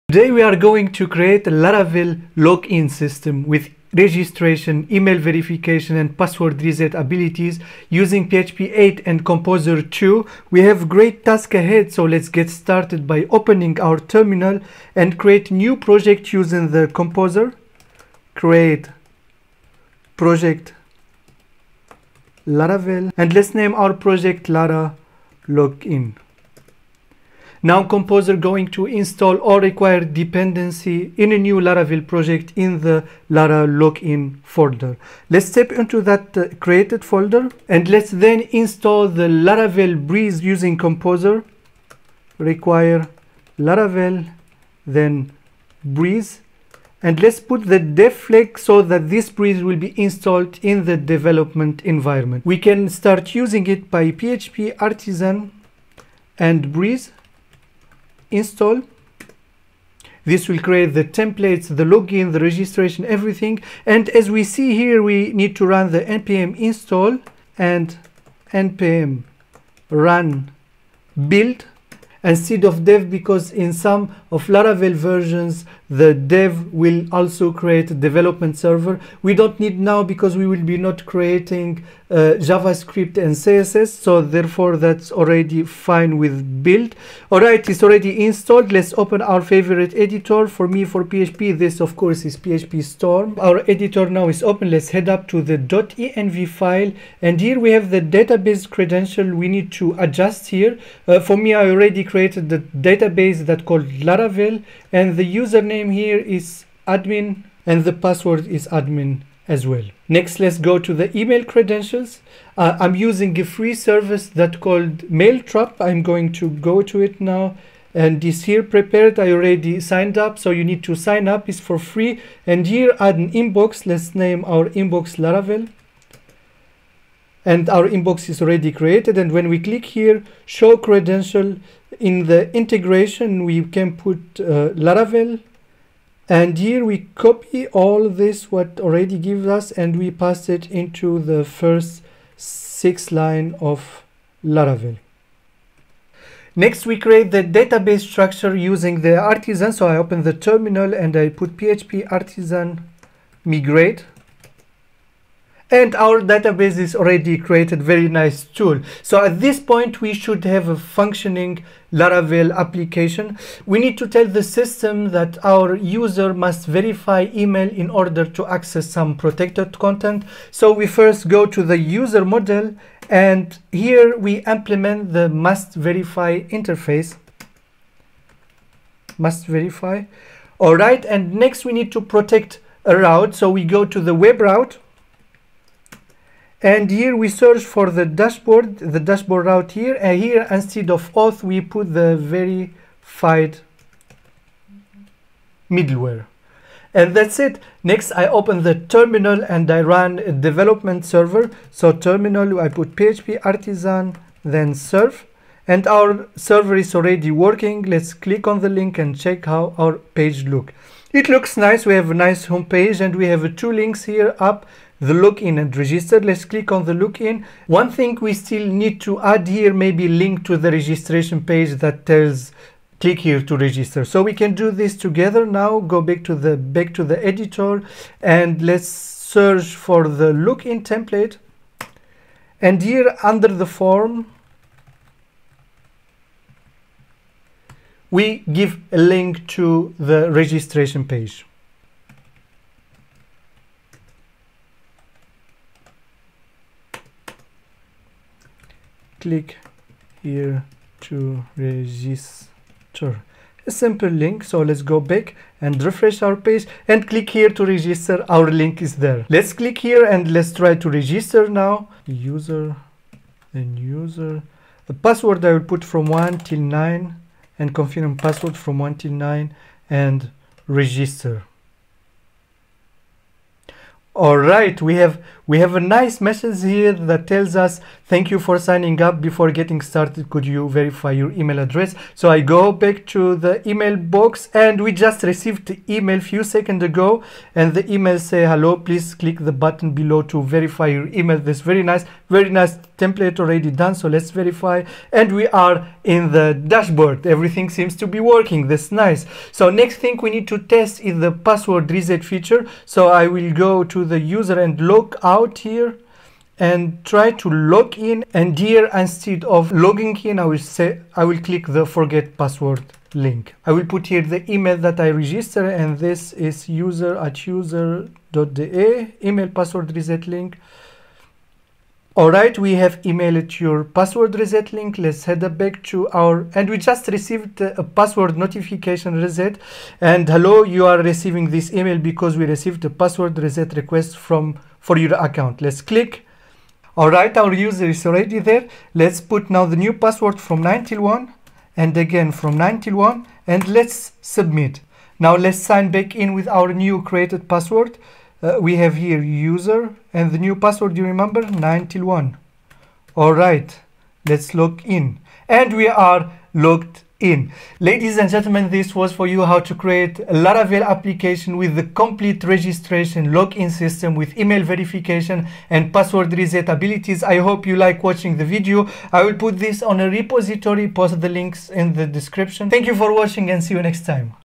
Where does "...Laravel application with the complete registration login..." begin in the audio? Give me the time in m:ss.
6:00.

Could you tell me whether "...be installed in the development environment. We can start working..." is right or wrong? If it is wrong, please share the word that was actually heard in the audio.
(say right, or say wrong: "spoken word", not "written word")
wrong: "using", not "working".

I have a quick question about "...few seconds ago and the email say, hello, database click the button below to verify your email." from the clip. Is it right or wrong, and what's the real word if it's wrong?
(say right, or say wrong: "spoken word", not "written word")
wrong: "please", not "database".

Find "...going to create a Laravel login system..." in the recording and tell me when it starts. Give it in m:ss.
0:00.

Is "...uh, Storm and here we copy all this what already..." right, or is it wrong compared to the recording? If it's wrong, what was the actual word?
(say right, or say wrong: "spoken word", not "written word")
wrong: "Laravel", not "Storm".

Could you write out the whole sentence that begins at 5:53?
Alright, let's log in and we are logged in.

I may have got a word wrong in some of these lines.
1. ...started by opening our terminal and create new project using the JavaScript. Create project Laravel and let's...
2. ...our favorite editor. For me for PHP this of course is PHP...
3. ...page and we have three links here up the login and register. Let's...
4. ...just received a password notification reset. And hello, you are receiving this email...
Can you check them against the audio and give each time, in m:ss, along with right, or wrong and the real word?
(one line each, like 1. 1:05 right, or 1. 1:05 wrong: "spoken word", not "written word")
1. 0:12 wrong: "Composer", not "JavaScript"
2. 1:29 right
3. 3:32 wrong: "two", not "three"
4. 5:26 right.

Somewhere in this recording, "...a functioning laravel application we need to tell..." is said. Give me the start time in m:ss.
2:40.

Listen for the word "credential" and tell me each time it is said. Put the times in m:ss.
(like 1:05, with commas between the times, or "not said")
1:38, 1:51, 2:10.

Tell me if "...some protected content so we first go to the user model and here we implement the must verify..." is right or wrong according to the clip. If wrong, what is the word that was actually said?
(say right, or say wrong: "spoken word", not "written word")
right.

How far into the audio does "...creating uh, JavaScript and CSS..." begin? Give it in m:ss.
1:21.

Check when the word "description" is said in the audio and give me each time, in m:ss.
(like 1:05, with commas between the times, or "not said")
6:12.